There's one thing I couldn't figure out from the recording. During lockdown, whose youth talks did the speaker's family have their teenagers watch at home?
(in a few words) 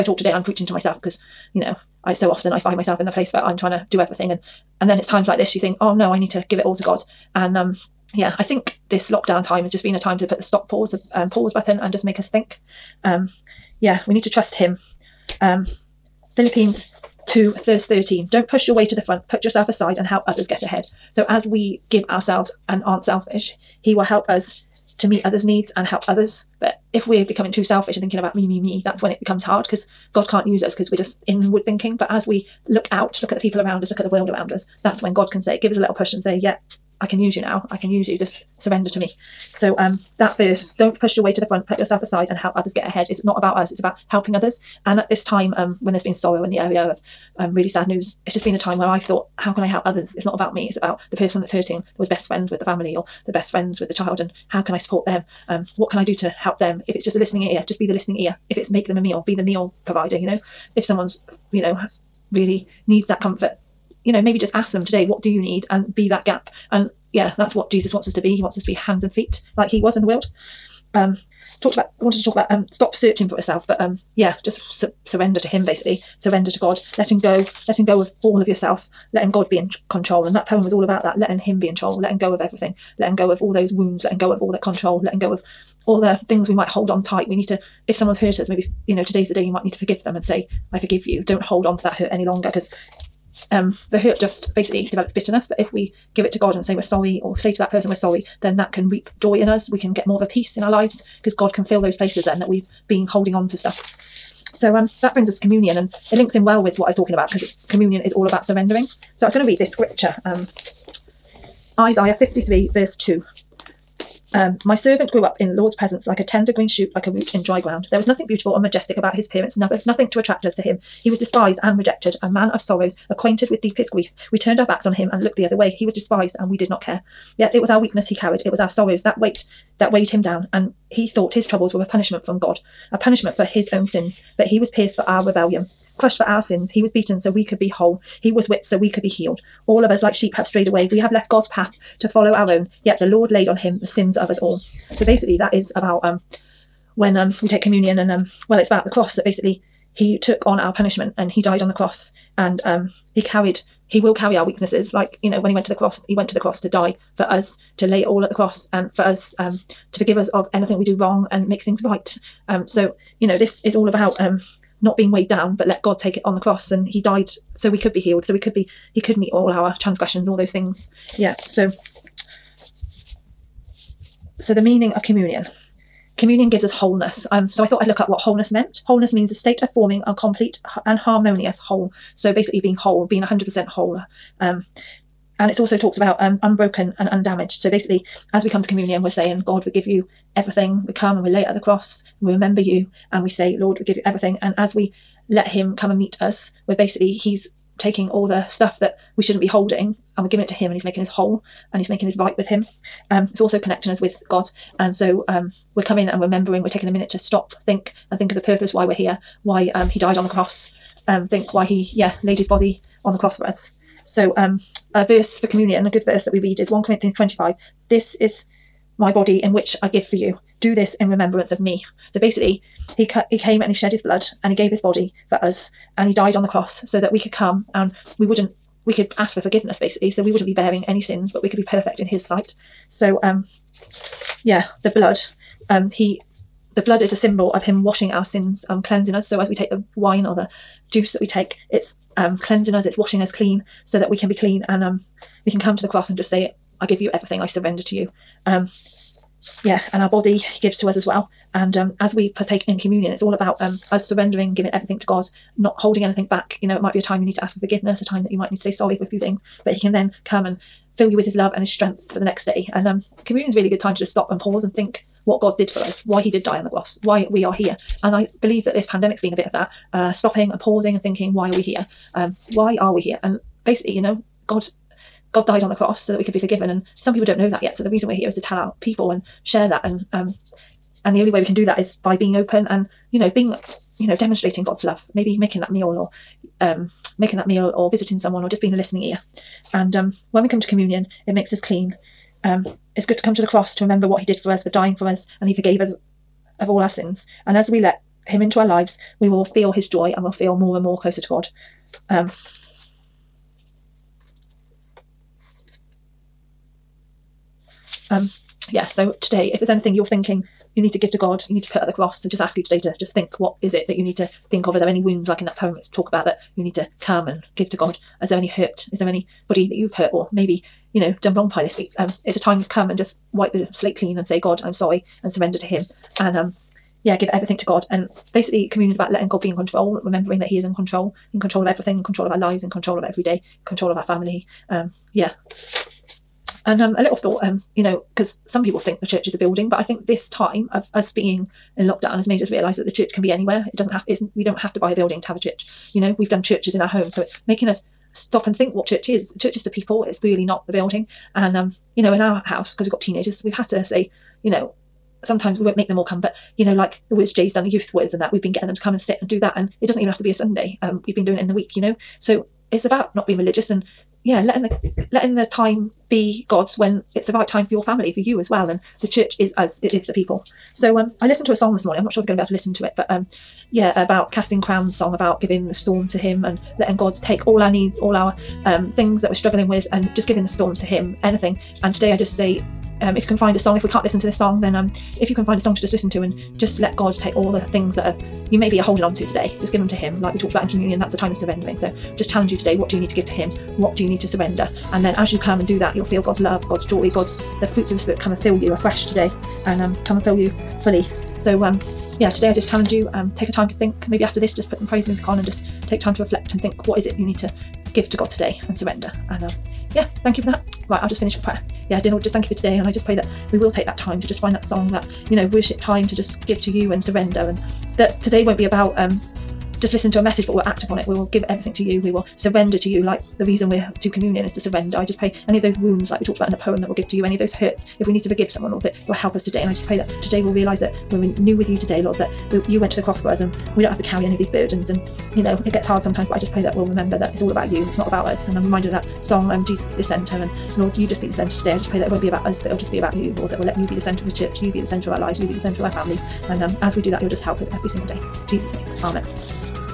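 Jay.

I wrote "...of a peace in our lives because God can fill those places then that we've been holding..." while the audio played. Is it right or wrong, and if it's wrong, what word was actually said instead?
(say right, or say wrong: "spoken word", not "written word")
right.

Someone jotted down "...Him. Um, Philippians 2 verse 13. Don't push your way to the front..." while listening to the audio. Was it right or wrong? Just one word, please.
right.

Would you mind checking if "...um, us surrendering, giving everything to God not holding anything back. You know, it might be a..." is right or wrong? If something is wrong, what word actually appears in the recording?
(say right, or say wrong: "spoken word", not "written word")
right.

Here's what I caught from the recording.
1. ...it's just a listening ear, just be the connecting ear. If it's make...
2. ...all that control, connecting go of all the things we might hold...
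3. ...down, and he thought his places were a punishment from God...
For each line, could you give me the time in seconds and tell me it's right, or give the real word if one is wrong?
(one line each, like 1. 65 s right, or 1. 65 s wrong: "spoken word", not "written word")
1. 56 s wrong: "listening", not "connecting"
2. 84 s wrong: "letting", not "connecting"
3. 130 s wrong: "troubles", not "places".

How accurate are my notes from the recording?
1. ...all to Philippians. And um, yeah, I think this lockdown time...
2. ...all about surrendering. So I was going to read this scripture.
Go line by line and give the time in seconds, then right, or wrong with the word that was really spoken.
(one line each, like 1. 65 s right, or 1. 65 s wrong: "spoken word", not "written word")
1. 6 s wrong: "God", not "Philippians"
2. 108 s right.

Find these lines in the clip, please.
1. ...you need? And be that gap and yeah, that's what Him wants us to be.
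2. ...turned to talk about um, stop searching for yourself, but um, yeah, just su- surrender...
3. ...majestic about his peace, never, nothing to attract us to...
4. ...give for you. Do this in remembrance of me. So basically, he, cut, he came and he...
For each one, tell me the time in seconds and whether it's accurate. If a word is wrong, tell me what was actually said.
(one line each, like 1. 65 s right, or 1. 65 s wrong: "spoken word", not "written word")
1. 65 s wrong: "Jesus", not "Him"
2. 71 s wrong: "wanted", not "turned"
3. 118 s wrong: "appearance", not "peace"
4. 219 s right.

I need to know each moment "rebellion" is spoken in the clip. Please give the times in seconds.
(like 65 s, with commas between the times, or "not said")
135 s.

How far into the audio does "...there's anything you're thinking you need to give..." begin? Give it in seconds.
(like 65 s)
309 s.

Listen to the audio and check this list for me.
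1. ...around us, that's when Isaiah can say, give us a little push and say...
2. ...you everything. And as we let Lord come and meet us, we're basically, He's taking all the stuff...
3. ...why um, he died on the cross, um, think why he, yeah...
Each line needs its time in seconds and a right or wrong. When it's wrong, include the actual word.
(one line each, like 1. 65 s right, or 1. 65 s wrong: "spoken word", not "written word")
1. 34 s wrong: "God", not "Isaiah"
2. 193 s wrong: "Him", not "Lord"
3. 209 s right.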